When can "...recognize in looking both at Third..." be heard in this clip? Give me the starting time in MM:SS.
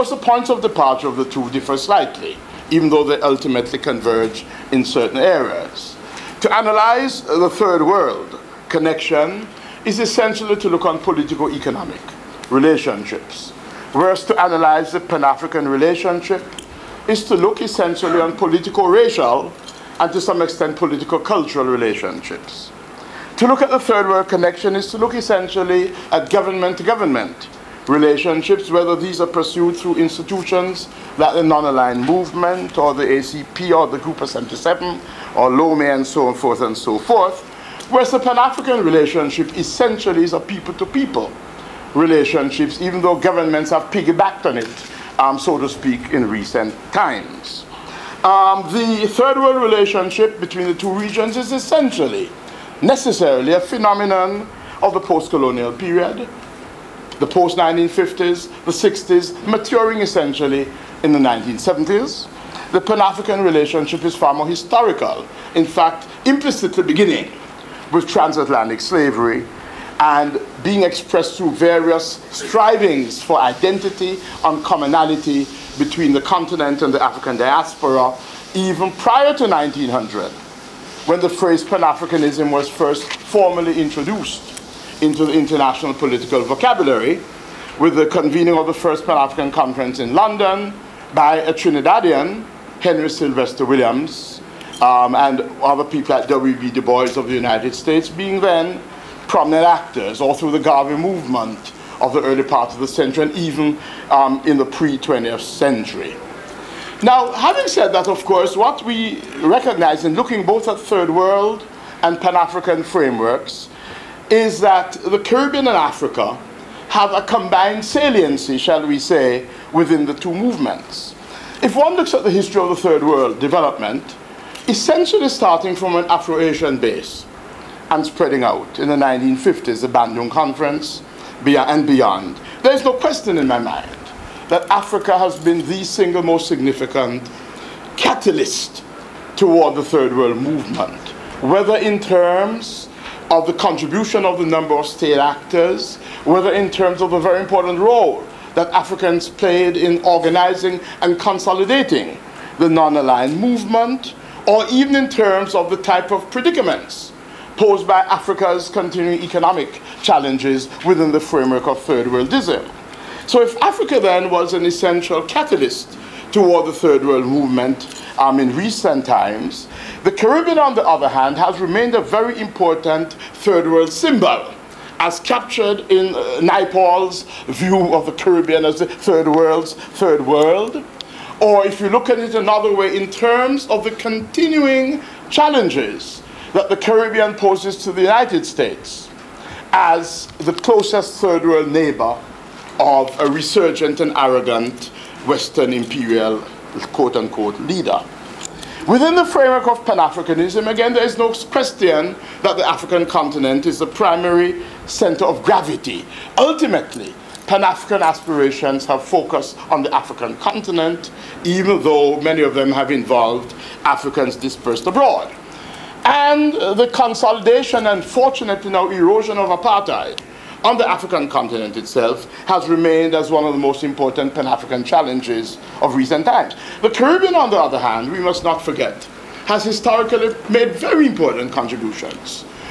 01:49.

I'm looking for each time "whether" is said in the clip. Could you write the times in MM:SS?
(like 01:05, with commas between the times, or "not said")
00:28, 02:21, 02:26.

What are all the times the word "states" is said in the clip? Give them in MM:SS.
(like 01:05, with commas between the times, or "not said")
01:37, 02:24, 03:08.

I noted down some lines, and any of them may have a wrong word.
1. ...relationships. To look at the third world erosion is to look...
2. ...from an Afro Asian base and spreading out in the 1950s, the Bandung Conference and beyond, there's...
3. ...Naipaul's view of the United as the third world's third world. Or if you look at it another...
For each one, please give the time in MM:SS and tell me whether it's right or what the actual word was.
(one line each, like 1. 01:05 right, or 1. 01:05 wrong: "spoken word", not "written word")
1. 00:21 wrong: "connection", not "erosion"
2. 02:05 right
3. 02:56 wrong: "Caribbean", not "United".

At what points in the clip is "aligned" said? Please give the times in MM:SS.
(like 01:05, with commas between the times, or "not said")
00:31, 02:32.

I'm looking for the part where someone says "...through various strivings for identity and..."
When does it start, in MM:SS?
01:11.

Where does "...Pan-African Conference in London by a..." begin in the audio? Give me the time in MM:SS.
01:29.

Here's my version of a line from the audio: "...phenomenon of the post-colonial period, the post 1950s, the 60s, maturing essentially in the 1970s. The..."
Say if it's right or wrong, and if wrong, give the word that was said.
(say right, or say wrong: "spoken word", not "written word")
right.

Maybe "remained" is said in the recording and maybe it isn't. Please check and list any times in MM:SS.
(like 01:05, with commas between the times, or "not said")
02:51, 03:42.